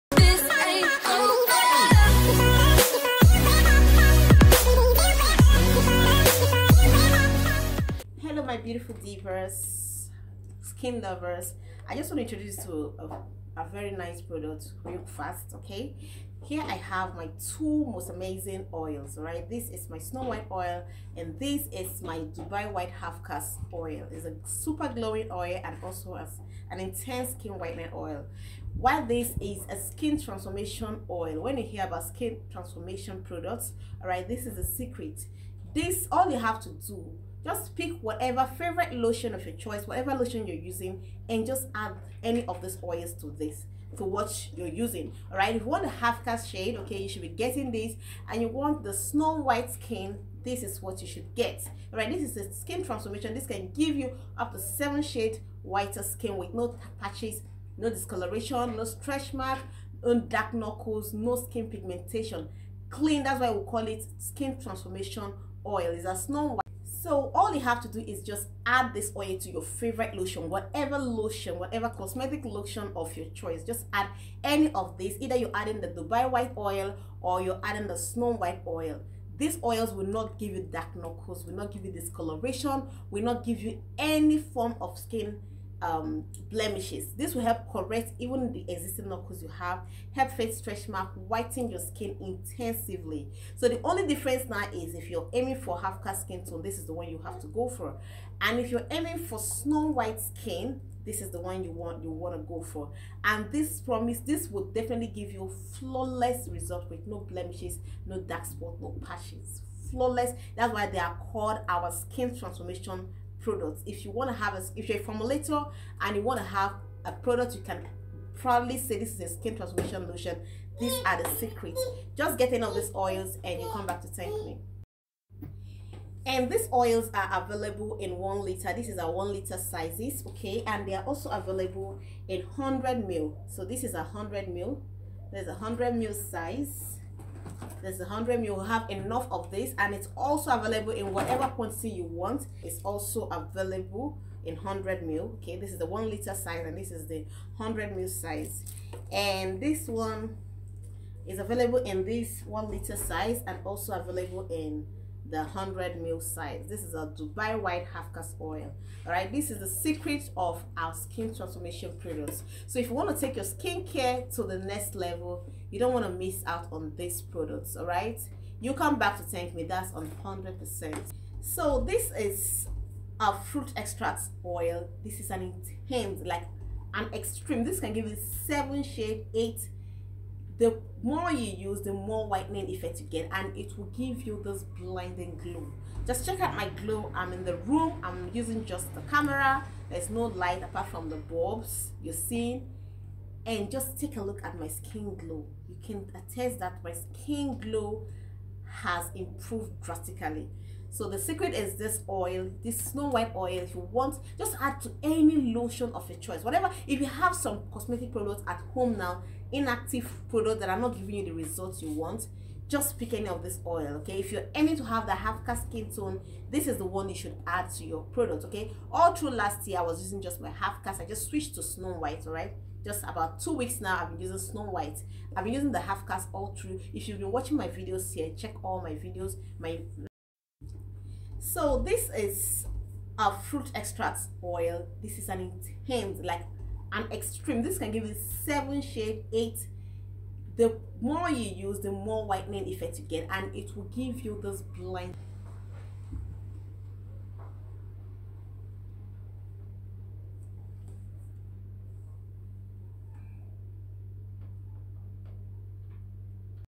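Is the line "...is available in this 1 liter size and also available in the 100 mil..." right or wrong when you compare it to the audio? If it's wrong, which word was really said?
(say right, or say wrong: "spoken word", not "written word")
right.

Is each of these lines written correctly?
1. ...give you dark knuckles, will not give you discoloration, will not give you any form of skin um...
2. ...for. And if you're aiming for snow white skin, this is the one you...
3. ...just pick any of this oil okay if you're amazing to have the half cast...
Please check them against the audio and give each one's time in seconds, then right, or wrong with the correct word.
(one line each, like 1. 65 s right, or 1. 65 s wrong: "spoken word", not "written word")
1. 80 s right
2. 97 s right
3. 212 s wrong: "aiming", not "amazing".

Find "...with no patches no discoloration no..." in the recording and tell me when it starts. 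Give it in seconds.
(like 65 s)
56 s.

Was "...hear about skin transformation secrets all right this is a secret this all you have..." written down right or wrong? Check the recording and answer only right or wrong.
wrong.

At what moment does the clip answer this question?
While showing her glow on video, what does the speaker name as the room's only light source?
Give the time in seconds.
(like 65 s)
191 s.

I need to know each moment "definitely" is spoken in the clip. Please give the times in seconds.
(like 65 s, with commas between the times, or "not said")
104 s.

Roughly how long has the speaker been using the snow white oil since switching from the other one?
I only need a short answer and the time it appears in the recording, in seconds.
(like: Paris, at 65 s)
2 weeks, at 223 s.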